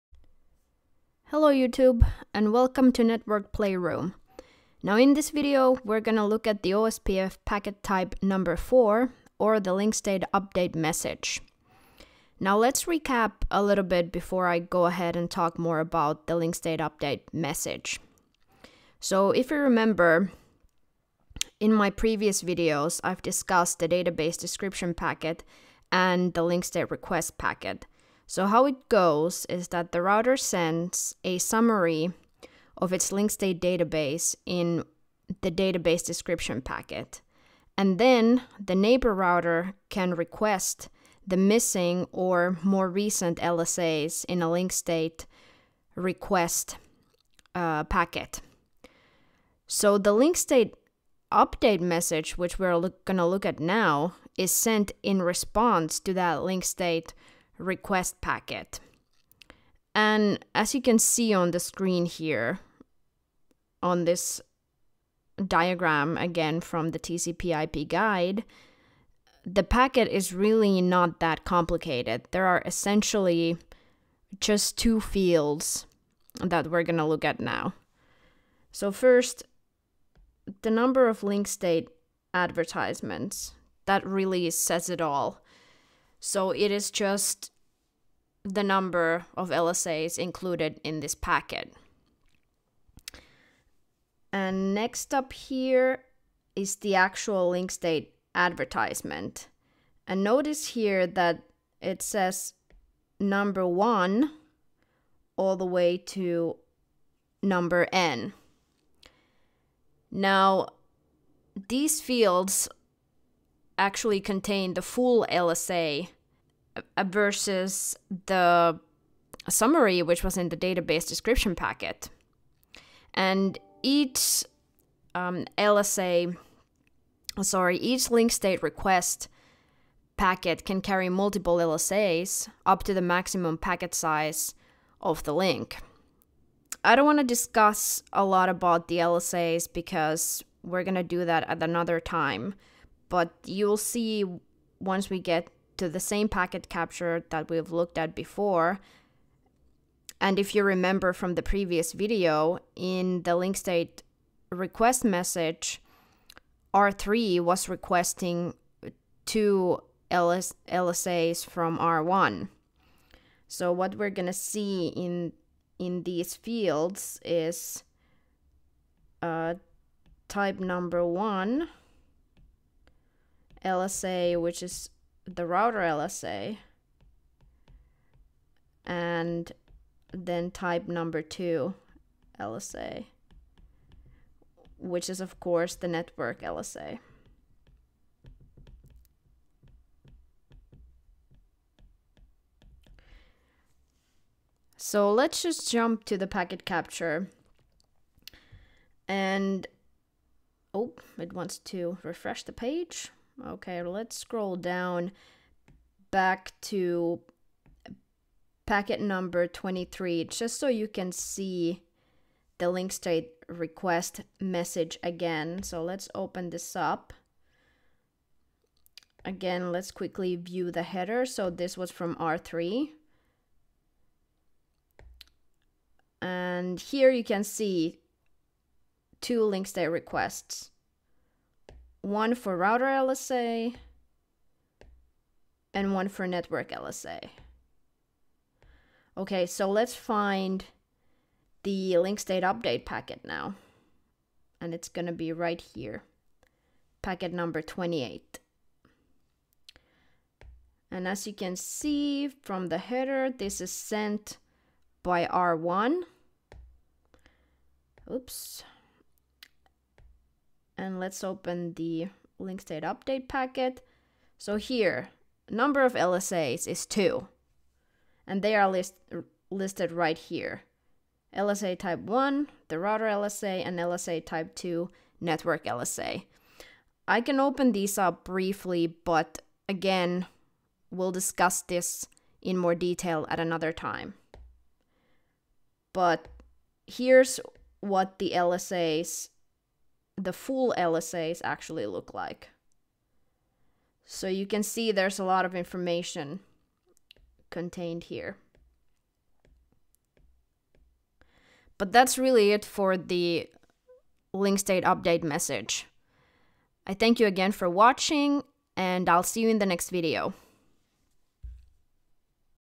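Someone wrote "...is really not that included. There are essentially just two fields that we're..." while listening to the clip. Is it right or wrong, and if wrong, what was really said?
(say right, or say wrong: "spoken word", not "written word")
wrong: "complicated", not "included".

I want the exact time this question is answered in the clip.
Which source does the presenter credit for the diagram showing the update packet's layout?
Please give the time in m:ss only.
1:06.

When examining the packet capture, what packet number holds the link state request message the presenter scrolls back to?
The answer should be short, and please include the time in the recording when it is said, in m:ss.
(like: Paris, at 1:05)
23, at 3:29.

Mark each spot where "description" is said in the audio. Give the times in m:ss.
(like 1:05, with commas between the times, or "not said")
0:24, 0:36, 2:01.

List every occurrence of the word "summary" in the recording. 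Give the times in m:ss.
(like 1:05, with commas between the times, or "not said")
0:31, 1:59.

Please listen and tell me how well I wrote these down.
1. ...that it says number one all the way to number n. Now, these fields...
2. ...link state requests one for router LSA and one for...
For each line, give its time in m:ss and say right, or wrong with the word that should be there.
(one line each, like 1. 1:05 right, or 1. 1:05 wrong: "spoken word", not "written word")
1. 1:41 right
2. 3:49 right.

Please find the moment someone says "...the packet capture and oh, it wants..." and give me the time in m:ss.
3:16.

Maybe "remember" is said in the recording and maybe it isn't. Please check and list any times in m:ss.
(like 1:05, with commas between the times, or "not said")
0:19, 2:30.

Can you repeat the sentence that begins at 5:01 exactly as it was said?
But that's really it for the link state update message.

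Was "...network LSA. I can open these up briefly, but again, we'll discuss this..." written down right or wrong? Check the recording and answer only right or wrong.
right.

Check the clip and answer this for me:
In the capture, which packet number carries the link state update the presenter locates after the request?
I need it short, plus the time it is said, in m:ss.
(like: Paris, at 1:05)
28, at 4:07.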